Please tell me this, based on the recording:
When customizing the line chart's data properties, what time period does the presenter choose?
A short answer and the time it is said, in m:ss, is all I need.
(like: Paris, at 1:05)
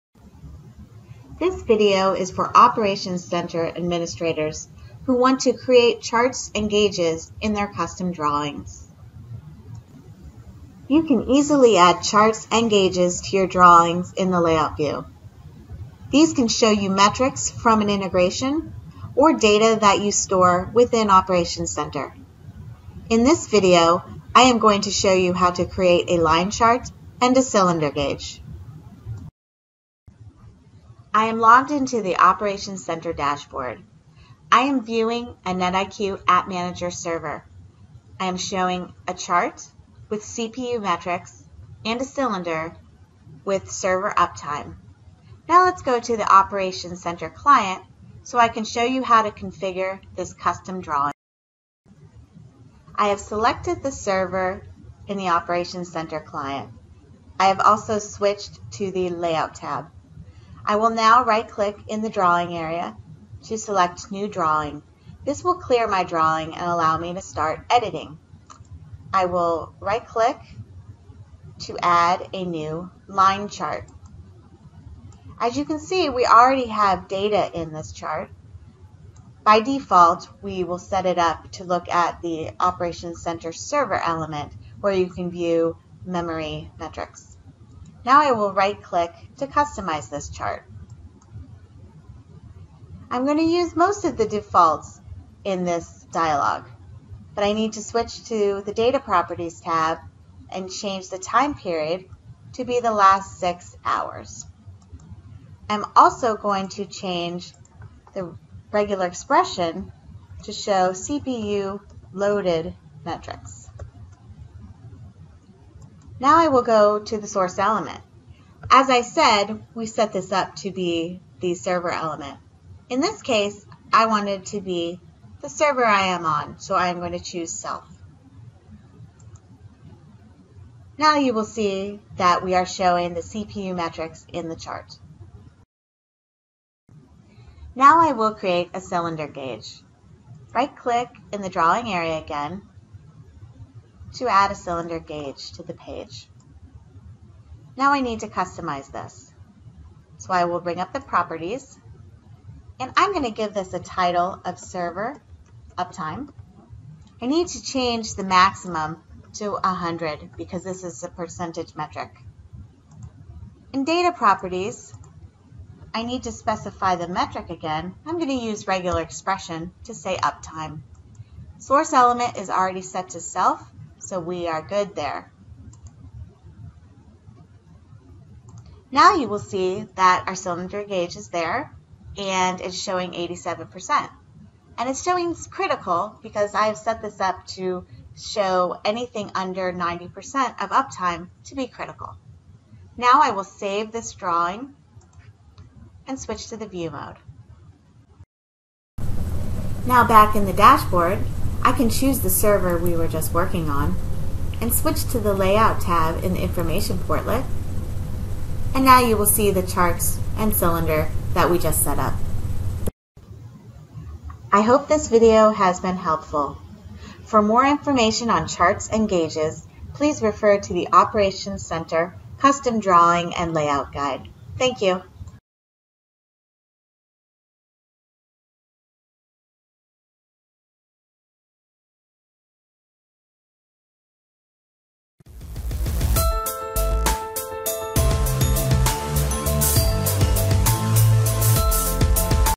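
last six hours, at 1:42.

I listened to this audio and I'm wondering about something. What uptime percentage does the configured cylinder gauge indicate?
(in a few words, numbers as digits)
87%.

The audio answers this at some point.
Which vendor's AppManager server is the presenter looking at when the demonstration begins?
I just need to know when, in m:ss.
0:35.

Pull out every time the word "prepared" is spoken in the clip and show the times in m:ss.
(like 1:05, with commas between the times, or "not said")
not said.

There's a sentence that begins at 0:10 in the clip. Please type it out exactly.
You can easily add charts and gauges to your drawings in the layout view.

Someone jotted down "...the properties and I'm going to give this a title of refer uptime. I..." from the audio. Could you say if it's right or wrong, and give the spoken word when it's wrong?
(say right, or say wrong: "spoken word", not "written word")
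wrong: "server", not "refer".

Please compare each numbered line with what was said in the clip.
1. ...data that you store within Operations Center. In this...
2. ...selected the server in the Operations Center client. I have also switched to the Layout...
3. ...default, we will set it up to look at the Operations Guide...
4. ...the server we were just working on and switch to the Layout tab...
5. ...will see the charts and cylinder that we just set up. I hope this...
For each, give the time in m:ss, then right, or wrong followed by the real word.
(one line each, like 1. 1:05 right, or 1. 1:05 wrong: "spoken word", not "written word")
1. 0:19 right
2. 0:53 right
3. 1:19 wrong: "Center", not "Guide"
4. 3:22 right
5. 3:29 right.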